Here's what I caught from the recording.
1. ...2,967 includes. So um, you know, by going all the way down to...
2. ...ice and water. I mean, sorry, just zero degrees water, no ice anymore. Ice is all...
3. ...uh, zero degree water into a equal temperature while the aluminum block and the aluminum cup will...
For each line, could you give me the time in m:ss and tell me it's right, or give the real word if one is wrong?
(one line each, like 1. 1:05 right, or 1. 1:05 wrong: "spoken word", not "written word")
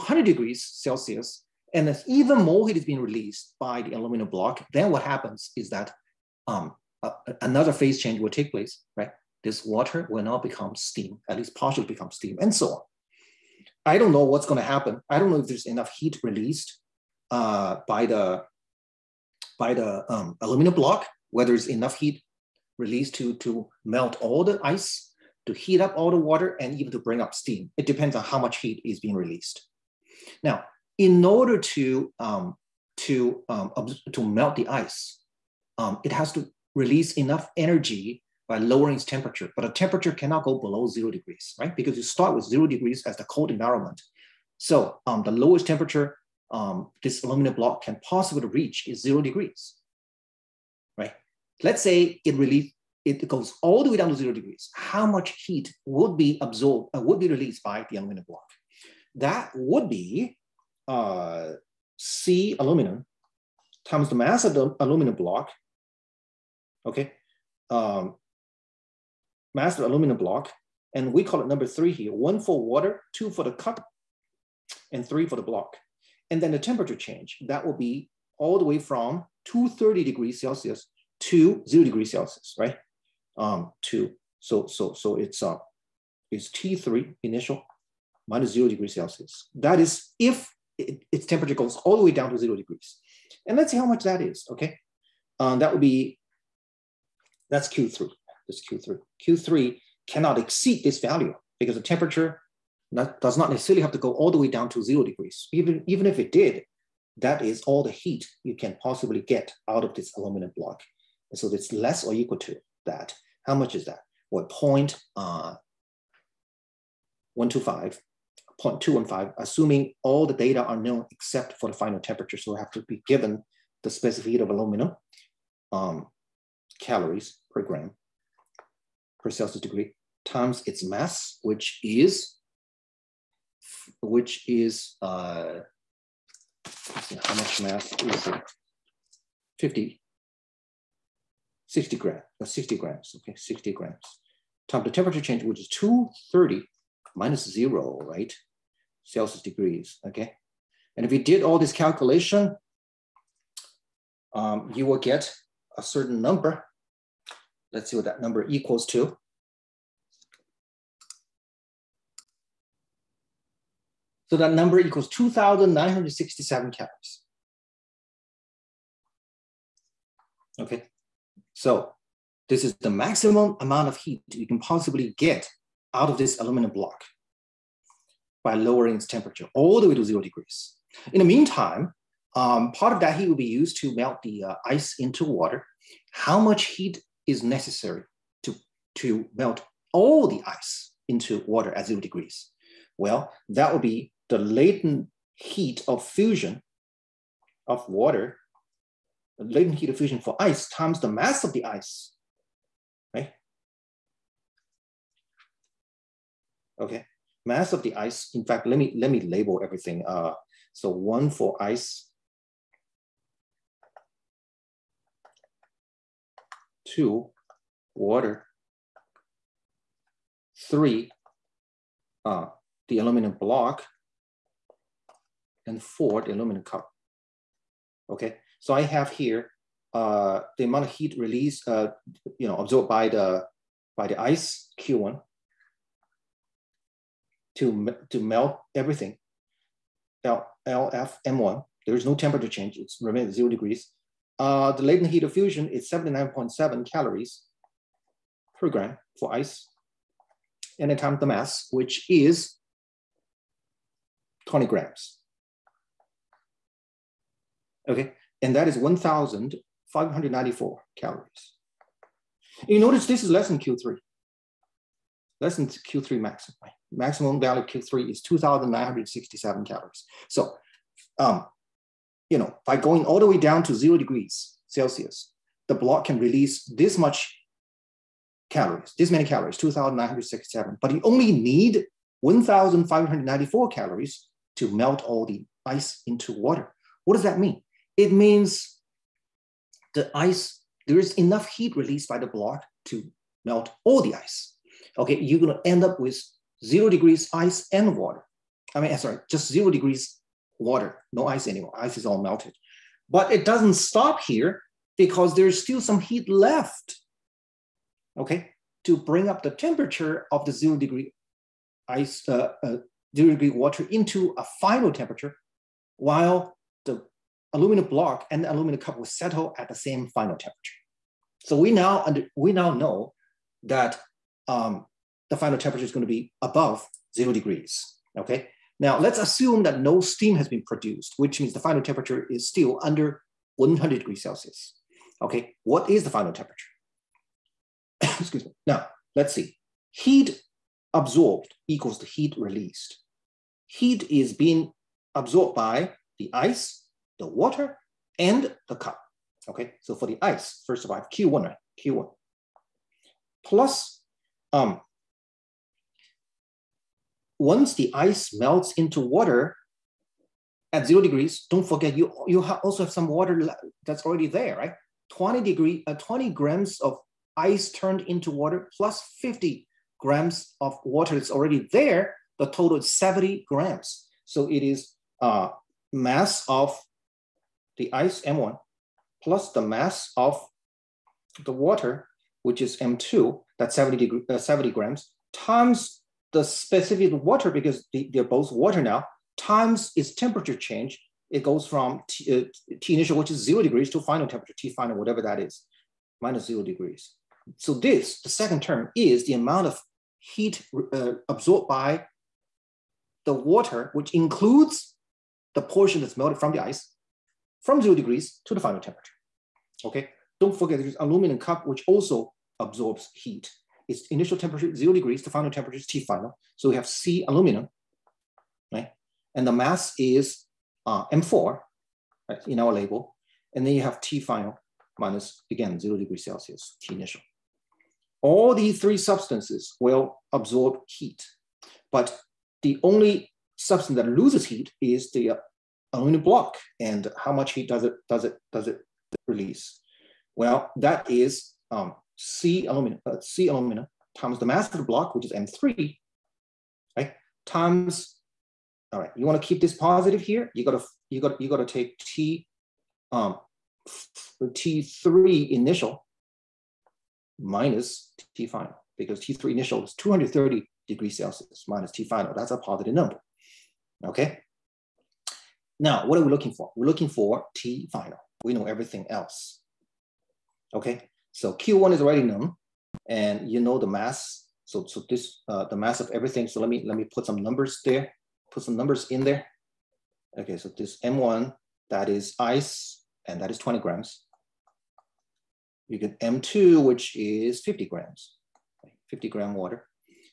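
1. 4:28 wrong: "calories", not "includes"
2. 4:57 right
3. 5:12 wrong: "final", not "equal".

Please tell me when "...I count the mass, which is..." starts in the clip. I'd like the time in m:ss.
4:10.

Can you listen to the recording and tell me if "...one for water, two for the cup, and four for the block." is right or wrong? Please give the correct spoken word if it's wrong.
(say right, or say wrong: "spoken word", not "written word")
wrong: "three", not "four".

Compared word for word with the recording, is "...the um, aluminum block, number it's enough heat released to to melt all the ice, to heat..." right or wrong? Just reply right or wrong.
wrong.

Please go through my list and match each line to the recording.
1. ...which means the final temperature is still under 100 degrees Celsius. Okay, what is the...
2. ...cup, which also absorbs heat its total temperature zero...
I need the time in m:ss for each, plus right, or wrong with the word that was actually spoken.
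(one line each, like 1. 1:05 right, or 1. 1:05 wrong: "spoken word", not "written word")
1. 5:31 right
2. 6:51 wrong: "initial", not "total".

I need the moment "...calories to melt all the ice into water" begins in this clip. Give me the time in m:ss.
4:43.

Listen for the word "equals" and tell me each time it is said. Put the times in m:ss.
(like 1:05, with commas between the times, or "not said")
1:52, 2:38, 2:44, 5:41.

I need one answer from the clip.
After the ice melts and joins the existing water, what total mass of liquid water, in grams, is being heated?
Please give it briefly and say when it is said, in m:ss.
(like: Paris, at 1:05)
70 grams, at 6:12.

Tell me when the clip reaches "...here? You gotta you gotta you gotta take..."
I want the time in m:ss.
7:30.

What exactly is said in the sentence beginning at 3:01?
In the meantime, um, part of that heat will be used to melt the uh, ice into water.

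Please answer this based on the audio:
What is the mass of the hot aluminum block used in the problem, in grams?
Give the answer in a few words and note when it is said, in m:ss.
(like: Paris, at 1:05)
60 grams, at 2:22.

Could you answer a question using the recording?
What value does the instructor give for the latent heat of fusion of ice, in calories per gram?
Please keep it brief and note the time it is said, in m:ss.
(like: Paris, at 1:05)
79.7, at 4:05.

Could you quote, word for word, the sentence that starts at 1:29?
That is if it, its temperature goes all the way down to zero degrees.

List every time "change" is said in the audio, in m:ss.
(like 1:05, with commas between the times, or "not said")
0:08, 1:16, 2:25, 4:02, 6:30.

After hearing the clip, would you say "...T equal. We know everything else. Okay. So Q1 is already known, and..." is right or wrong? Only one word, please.
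wrong.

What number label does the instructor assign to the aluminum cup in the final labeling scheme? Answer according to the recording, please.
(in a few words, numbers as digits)
4.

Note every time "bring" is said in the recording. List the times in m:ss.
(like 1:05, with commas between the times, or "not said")
0:27, 5:08.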